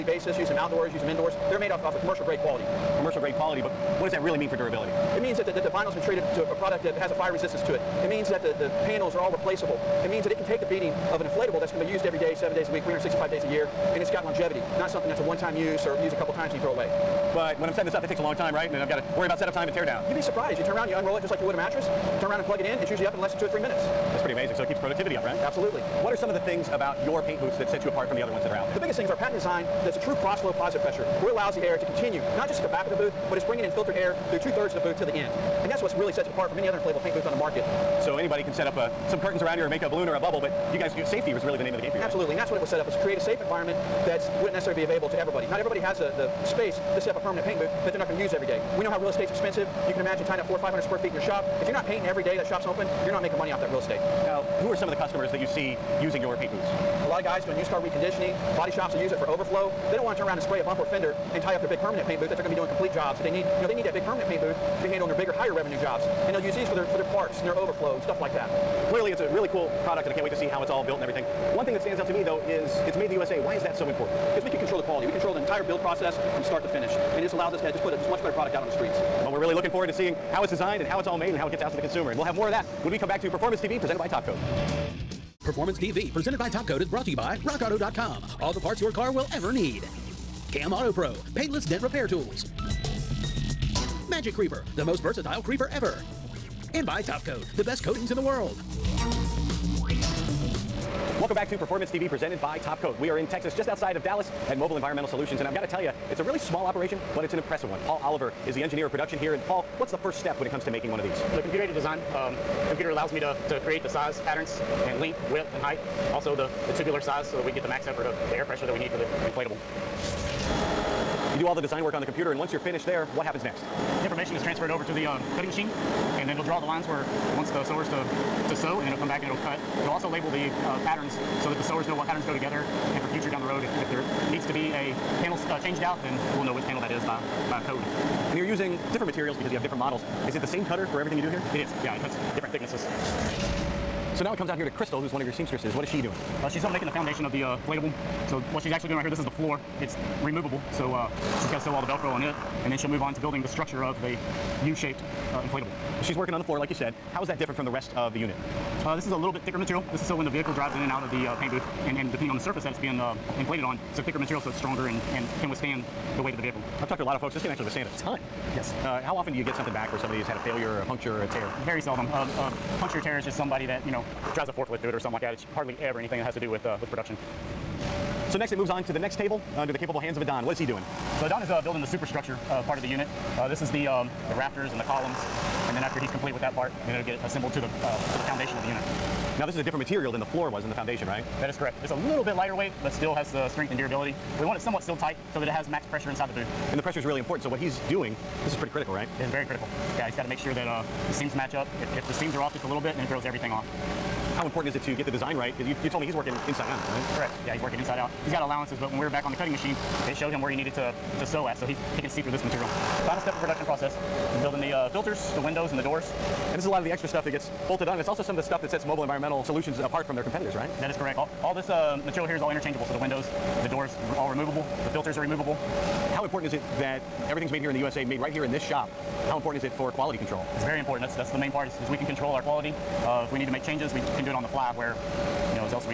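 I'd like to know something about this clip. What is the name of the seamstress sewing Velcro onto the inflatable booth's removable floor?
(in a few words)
Crystal.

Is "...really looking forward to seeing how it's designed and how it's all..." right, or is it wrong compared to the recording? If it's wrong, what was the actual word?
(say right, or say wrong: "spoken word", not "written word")
right.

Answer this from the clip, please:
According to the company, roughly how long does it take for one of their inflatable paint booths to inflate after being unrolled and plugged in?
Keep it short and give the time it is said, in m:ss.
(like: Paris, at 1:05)
2 or 3 minutes, at 0:23.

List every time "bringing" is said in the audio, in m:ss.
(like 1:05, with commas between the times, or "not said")
0:33.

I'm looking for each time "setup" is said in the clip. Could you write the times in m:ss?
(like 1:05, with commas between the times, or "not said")
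0:19.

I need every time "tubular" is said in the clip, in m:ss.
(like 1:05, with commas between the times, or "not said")
1:56.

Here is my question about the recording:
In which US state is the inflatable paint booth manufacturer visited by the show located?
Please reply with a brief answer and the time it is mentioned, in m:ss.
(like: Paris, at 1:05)
Texas, at 1:43.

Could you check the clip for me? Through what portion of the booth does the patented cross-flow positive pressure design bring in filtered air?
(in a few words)
two-thirds.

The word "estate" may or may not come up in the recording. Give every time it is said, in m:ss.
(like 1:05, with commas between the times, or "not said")
0:49, 0:53.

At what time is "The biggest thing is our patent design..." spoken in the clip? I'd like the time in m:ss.
0:28.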